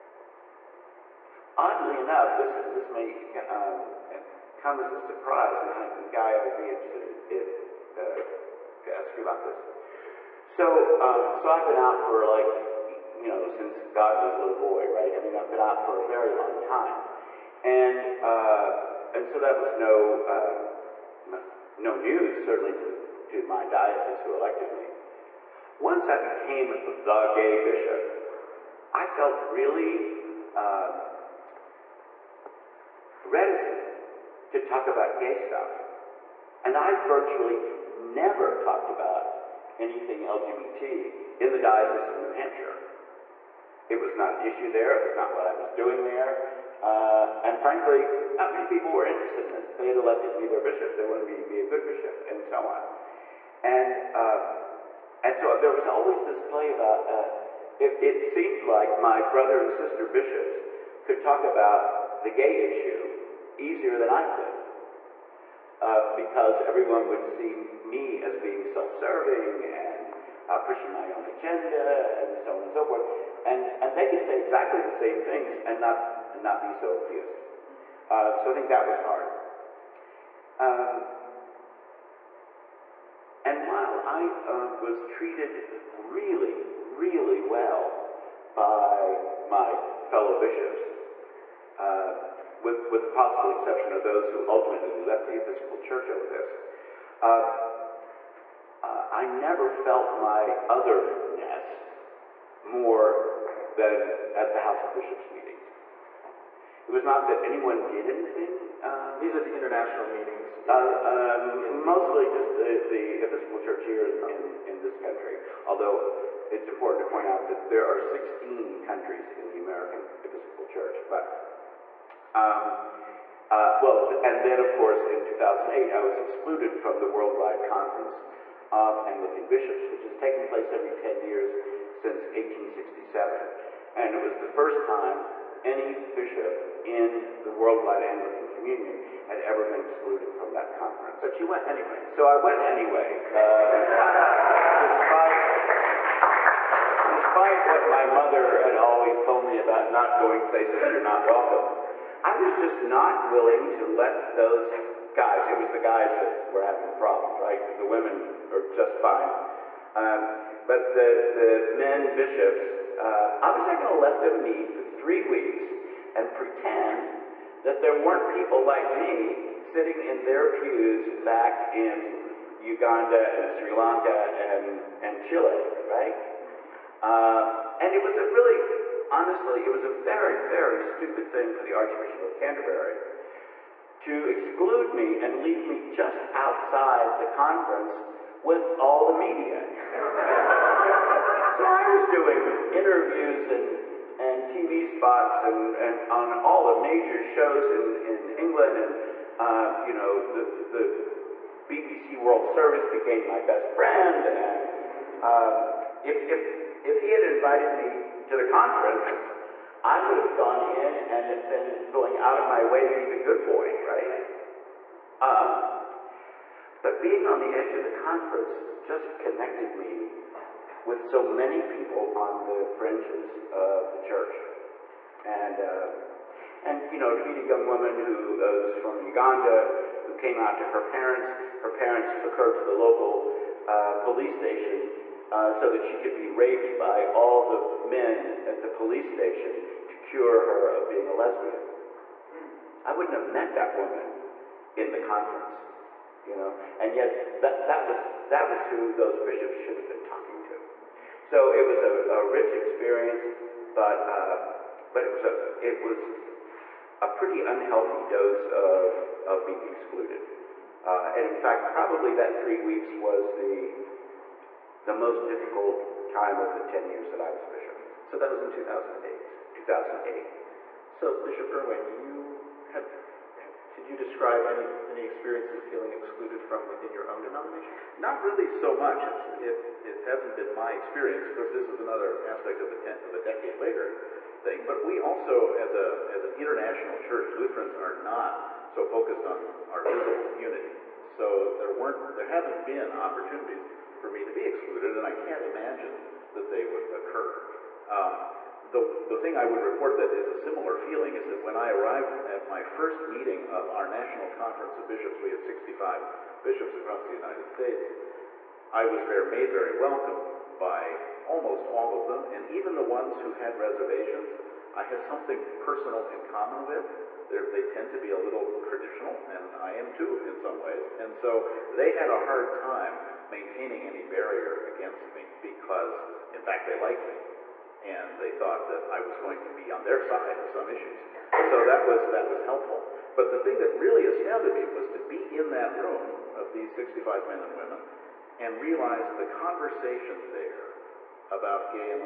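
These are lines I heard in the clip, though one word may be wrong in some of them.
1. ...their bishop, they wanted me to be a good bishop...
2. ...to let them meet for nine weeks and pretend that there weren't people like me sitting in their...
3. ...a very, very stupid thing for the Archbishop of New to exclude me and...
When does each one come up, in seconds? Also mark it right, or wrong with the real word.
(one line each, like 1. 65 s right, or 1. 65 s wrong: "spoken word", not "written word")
1. 50 s right
2. 163 s wrong: "three", not "nine"
3. 179 s wrong: "Canterbury", not "New".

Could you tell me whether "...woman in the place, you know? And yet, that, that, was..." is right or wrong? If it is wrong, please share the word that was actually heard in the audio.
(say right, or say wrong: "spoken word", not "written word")
wrong: "conference", not "place".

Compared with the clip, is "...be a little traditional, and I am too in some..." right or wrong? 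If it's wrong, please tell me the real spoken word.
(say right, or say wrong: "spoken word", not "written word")
right.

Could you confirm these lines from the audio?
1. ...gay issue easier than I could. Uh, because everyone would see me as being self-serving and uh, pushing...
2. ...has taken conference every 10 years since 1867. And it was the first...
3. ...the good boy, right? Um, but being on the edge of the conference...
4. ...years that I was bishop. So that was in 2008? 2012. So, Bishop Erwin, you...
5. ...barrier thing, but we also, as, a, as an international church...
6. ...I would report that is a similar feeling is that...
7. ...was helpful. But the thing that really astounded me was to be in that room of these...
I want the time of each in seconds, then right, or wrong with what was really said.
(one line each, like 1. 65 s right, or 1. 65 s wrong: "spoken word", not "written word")
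1. 62 s right
2. 130 s wrong: "place", not "conference"
3. 213 s right
4. 266 s wrong: "2008", not "2012"
5. 283 s wrong: "later", not "barrier"
6. 299 s right
7. 332 s right.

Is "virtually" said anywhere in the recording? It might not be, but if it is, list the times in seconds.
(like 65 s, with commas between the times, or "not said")
37 s.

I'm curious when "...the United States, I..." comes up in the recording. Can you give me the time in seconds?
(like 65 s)
307 s.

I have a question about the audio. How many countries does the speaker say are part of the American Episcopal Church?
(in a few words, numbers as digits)
16.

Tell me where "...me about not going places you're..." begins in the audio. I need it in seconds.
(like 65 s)
149 s.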